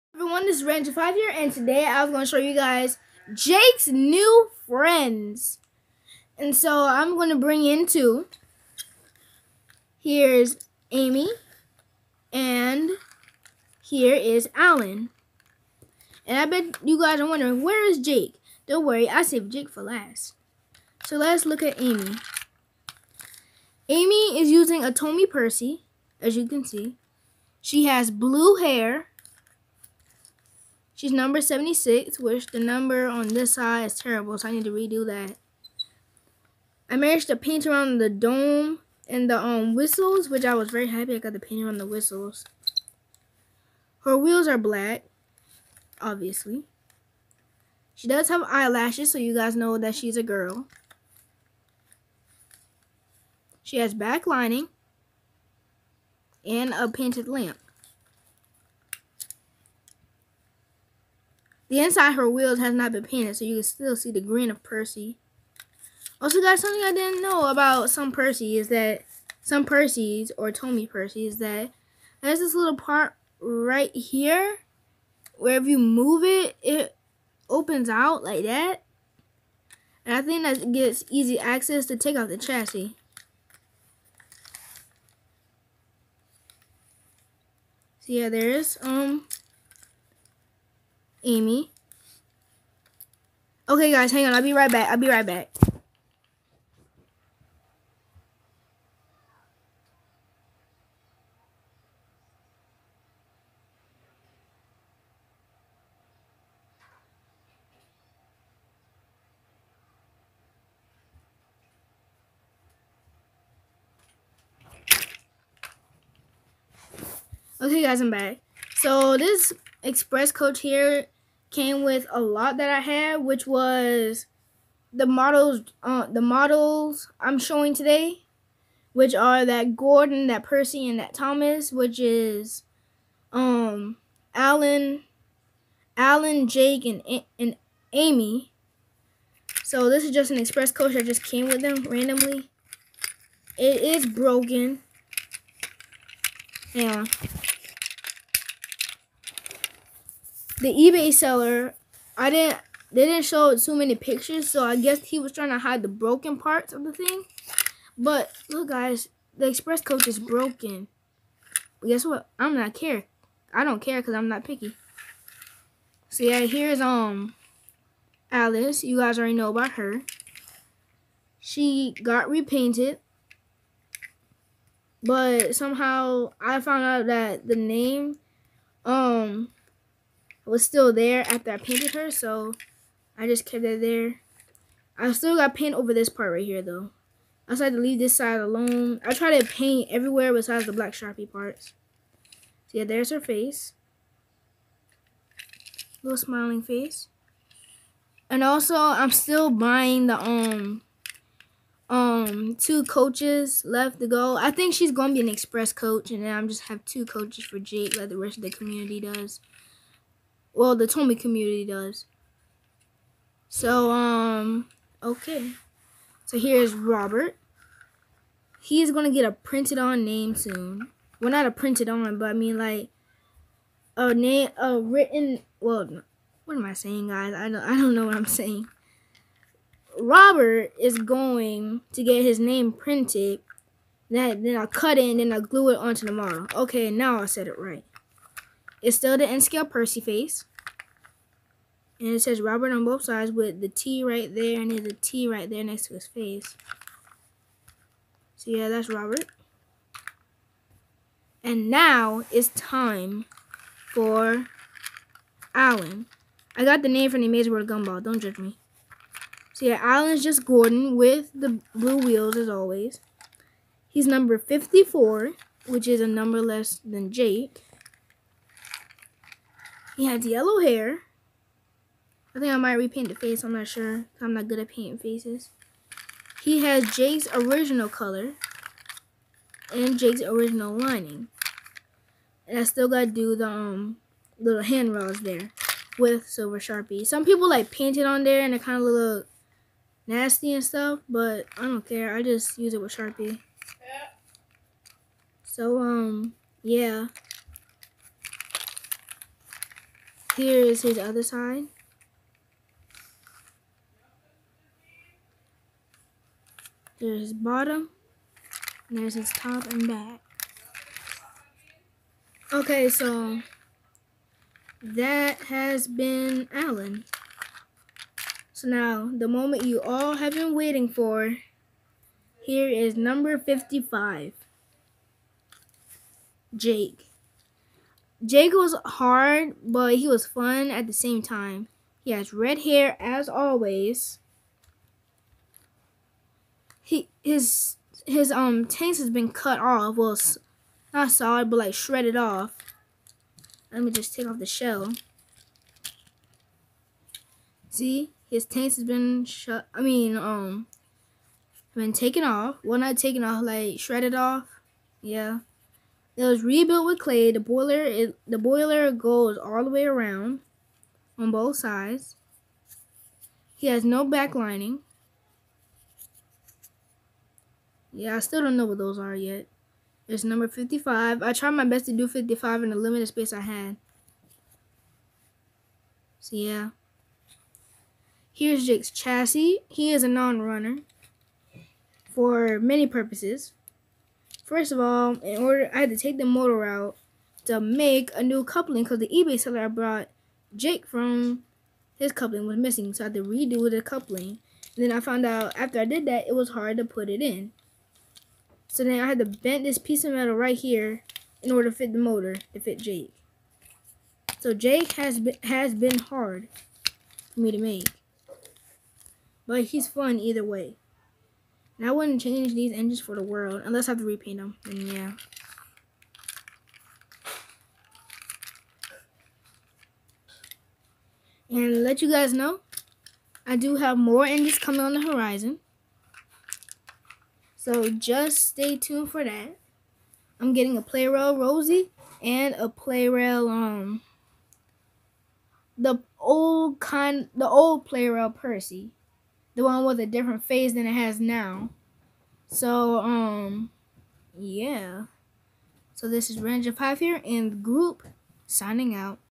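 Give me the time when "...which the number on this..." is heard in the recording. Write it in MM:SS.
00:32.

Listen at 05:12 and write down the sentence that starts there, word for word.
Okay, so that has been Alan.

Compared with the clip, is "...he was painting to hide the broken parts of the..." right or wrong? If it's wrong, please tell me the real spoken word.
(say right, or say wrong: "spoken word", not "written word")
wrong: "trying", not "painting".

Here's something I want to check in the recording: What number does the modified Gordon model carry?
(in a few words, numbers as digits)
54.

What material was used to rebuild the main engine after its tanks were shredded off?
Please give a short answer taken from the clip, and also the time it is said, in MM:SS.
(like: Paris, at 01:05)
Clay, at 05:56.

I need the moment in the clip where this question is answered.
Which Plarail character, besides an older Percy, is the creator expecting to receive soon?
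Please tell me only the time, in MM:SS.
07:11.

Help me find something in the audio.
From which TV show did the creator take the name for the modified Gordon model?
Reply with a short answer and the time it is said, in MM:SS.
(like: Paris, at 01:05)
The Amazing World of Gumball, at 04:17.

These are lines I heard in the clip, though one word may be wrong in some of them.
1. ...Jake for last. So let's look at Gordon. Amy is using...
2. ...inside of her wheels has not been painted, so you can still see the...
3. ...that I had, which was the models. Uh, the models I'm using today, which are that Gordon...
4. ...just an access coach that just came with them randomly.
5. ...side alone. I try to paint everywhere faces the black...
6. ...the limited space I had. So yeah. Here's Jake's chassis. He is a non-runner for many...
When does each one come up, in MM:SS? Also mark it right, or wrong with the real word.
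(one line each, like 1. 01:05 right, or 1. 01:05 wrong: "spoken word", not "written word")
1. 00:19 wrong: "Amy", not "Gordon"
2. 01:01 right
3. 02:02 wrong: "showing", not "using"
4. 02:20 wrong: "express", not "access"
5. 03:08 wrong: "besides", not "faces"
6. 06:12 right.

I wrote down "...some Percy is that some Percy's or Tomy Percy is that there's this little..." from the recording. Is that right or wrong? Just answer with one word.
right.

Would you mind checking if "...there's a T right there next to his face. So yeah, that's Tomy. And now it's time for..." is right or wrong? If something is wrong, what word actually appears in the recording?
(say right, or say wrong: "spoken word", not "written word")
wrong: "Robert", not "Tomy".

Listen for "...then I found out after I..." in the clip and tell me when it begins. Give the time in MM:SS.
06:34.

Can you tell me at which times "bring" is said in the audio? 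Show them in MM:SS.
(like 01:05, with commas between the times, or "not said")
00:07.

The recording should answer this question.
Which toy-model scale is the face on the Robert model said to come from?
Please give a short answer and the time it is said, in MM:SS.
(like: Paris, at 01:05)
N scale, at 03:59.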